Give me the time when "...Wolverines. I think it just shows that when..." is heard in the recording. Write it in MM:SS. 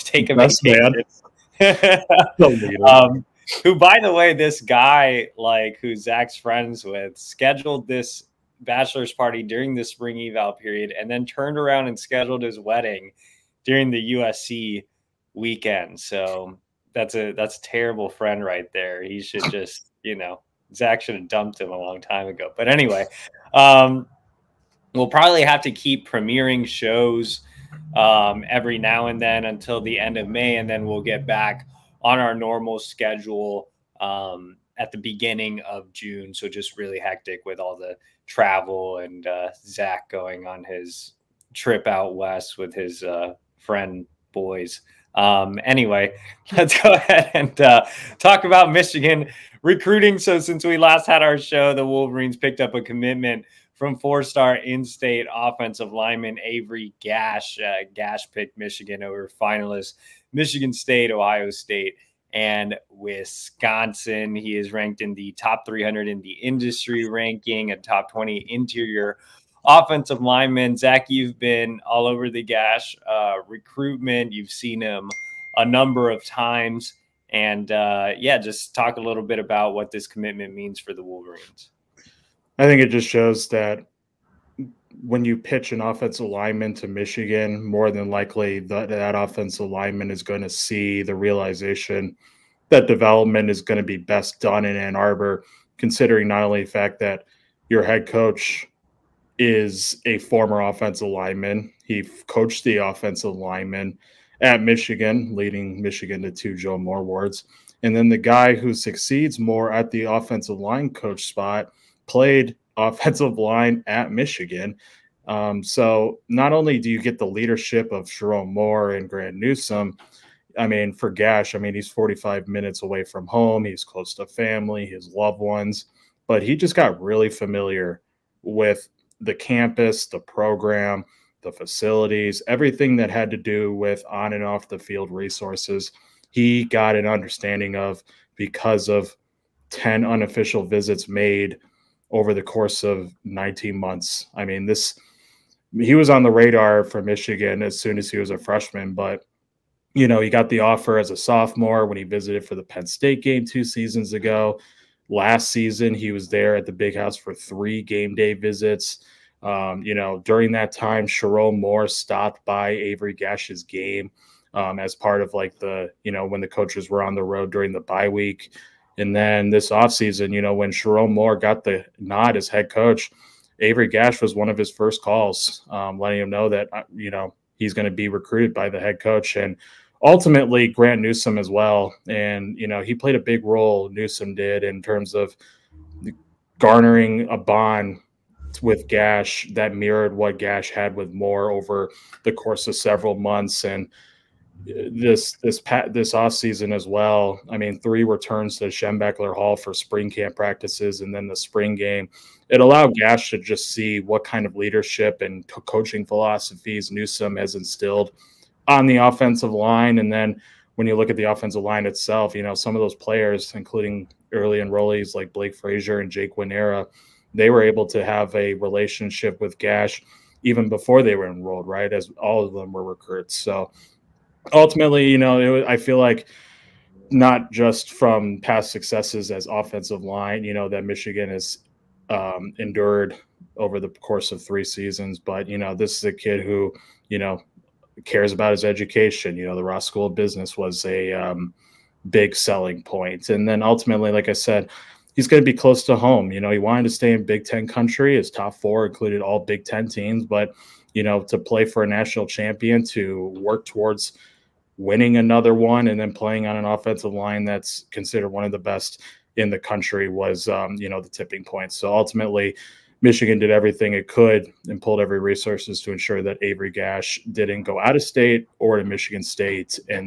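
01:21.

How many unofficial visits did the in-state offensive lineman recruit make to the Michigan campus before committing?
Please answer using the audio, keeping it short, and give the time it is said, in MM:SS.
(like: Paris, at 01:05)
10, at 02:19.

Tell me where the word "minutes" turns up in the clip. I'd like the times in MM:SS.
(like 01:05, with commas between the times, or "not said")
02:02.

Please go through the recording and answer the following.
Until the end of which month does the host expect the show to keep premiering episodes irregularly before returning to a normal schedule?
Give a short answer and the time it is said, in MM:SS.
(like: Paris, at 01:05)
May, at 00:30.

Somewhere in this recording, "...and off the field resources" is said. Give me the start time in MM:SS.
02:14.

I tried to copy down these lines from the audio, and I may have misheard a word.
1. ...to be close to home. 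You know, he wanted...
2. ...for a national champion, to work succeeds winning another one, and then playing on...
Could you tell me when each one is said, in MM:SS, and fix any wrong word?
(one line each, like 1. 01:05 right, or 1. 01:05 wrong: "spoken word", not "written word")
1. 04:05 right
2. 04:11 wrong: "towards", not "succeeds".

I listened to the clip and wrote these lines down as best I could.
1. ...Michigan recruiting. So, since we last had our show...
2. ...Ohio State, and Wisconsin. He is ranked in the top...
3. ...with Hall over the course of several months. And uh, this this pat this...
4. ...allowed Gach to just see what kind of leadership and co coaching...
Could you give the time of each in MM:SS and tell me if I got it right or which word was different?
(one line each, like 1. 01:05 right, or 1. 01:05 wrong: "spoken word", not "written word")
1. 00:48 right
2. 01:01 right
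3. 03:10 wrong: "Moore", not "Hall"
4. 03:22 right.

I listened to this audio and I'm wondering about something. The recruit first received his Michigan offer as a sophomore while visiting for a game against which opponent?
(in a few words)
Penn State.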